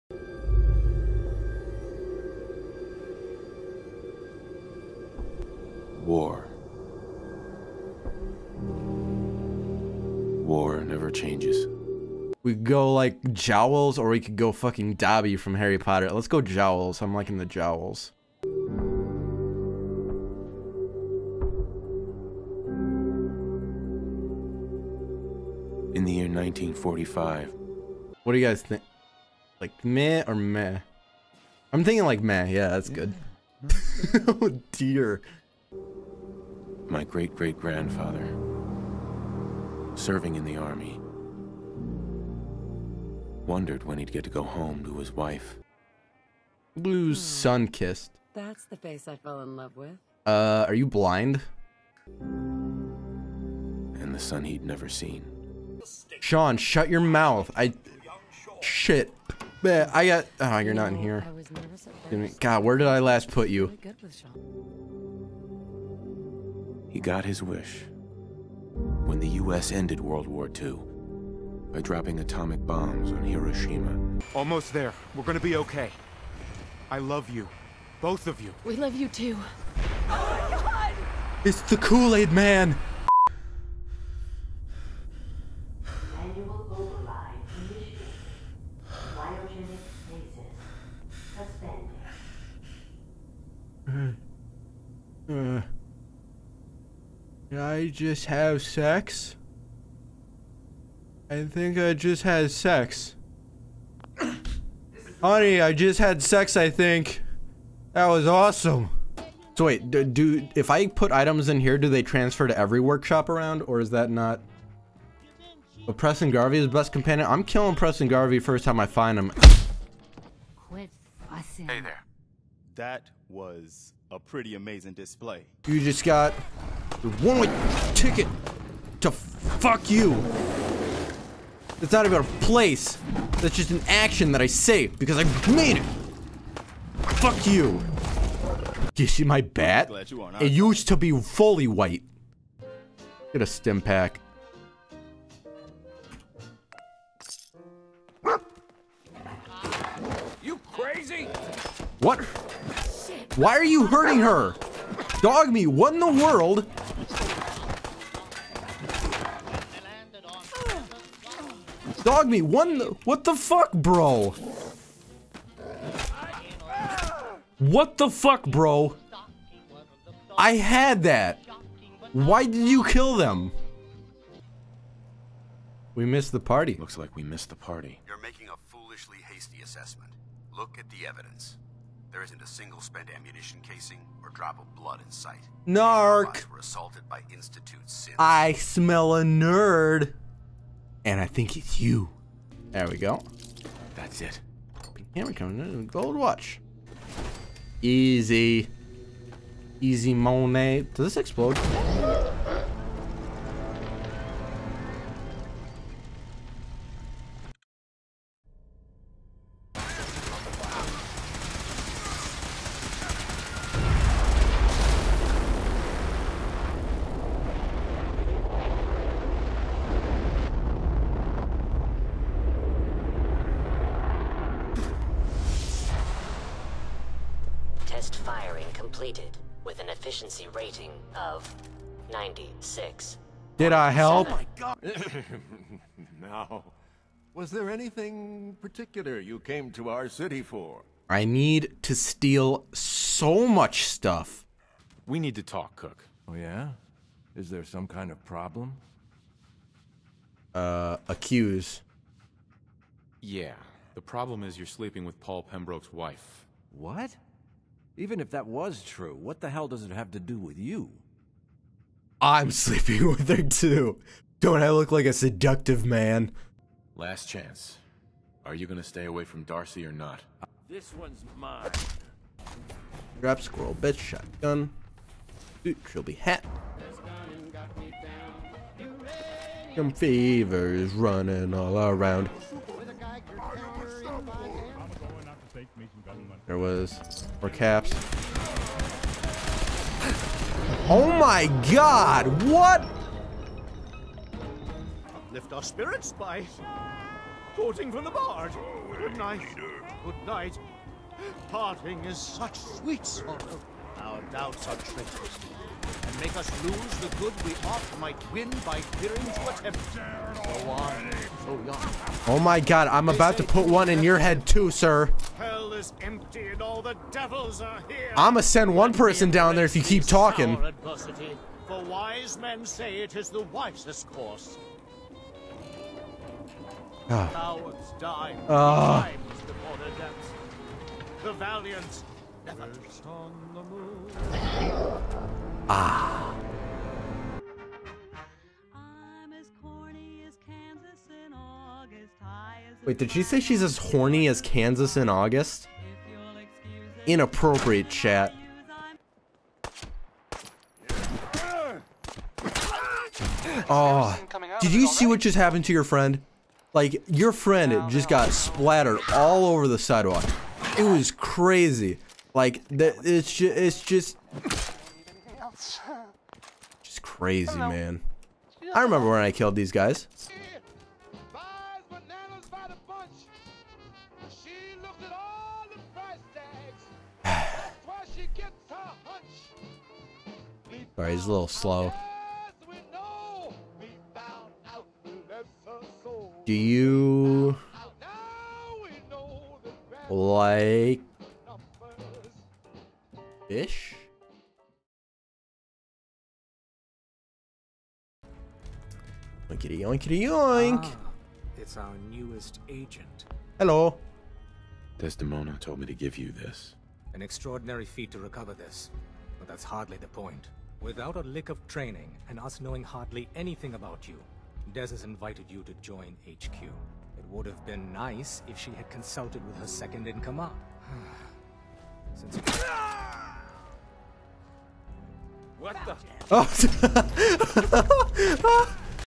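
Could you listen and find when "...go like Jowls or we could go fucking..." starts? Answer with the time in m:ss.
0:12.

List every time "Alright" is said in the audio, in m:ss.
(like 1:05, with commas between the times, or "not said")
6:21.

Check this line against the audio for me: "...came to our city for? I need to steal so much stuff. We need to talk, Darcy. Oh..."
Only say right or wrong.
wrong.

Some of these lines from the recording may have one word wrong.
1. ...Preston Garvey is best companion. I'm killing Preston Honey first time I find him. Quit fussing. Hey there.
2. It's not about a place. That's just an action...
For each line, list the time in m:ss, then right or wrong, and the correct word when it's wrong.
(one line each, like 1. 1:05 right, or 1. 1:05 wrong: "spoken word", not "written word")
1. 1:55 wrong: "Garvey", not "Honey"
2. 2:11 right.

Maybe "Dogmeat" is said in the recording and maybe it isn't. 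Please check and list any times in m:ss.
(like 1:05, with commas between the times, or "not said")
2:35, 2:42.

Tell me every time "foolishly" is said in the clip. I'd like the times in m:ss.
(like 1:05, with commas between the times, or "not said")
2:58.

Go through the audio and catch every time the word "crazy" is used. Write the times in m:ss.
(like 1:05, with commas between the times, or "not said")
2:30, 6:01, 6:07.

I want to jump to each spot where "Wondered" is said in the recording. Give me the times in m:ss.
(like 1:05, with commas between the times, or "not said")
0:43.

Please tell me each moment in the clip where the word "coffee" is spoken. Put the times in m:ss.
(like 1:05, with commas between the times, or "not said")
not said.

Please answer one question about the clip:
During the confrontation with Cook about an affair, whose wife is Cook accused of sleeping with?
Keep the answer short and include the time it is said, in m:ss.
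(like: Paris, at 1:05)
Paul Pembroke's wife, at 4:15.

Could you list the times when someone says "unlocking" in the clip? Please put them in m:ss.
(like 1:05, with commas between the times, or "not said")
not said.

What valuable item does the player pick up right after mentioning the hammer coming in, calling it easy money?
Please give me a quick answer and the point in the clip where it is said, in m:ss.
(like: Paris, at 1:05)
Gold watch, at 3:15.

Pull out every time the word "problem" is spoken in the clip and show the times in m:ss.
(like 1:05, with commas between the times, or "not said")
4:08, 4:14.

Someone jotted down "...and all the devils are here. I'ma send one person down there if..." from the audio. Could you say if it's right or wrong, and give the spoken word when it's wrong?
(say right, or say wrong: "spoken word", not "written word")
right.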